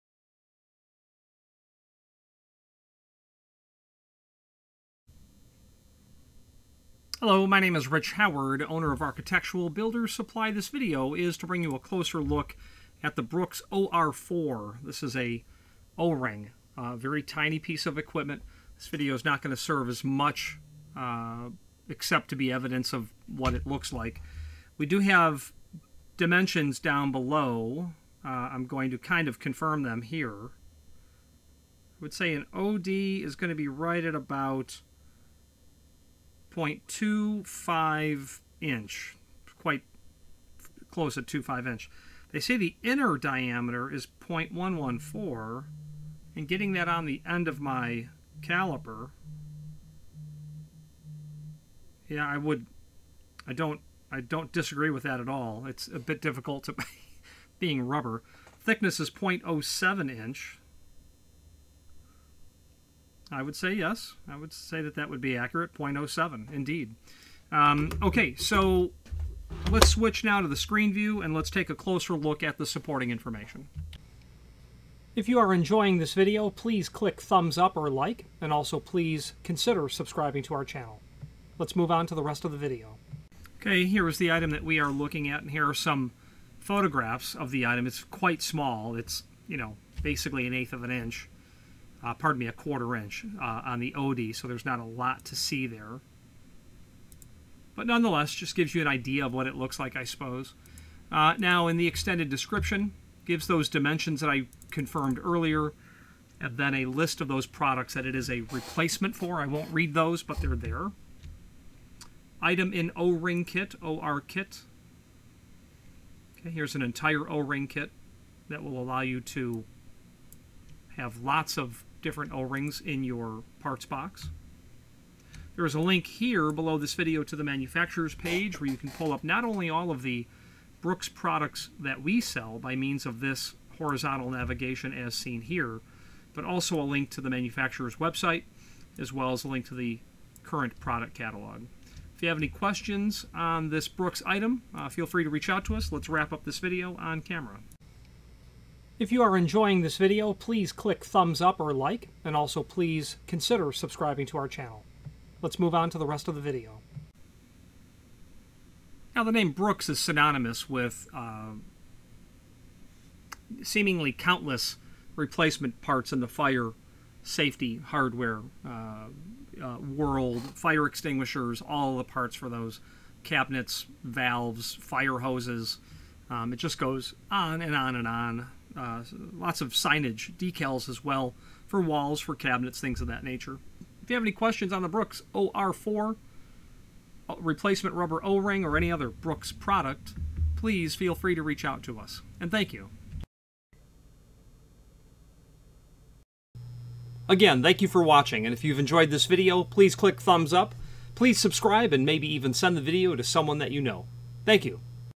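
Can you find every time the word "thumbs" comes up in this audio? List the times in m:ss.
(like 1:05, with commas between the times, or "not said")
1:17, 2:31, 3:20.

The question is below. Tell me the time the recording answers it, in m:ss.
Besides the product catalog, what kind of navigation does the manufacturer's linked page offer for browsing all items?
2:13.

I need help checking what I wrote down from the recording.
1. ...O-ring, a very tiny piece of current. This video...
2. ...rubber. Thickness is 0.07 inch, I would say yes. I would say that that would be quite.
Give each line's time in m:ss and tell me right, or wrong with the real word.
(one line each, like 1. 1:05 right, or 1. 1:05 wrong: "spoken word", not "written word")
1. 0:15 wrong: "equipment", not "current"
2. 0:57 wrong: "accurate", not "quite".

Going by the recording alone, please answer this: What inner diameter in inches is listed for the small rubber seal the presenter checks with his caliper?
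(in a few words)
0.114.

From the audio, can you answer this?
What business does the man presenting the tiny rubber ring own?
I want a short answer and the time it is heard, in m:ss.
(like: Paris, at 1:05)
Architectural Builders Supply, at 0:08.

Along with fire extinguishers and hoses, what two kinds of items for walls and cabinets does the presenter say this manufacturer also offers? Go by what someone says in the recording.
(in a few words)
signage, decals.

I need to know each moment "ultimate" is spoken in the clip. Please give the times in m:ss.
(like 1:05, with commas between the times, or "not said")
not said.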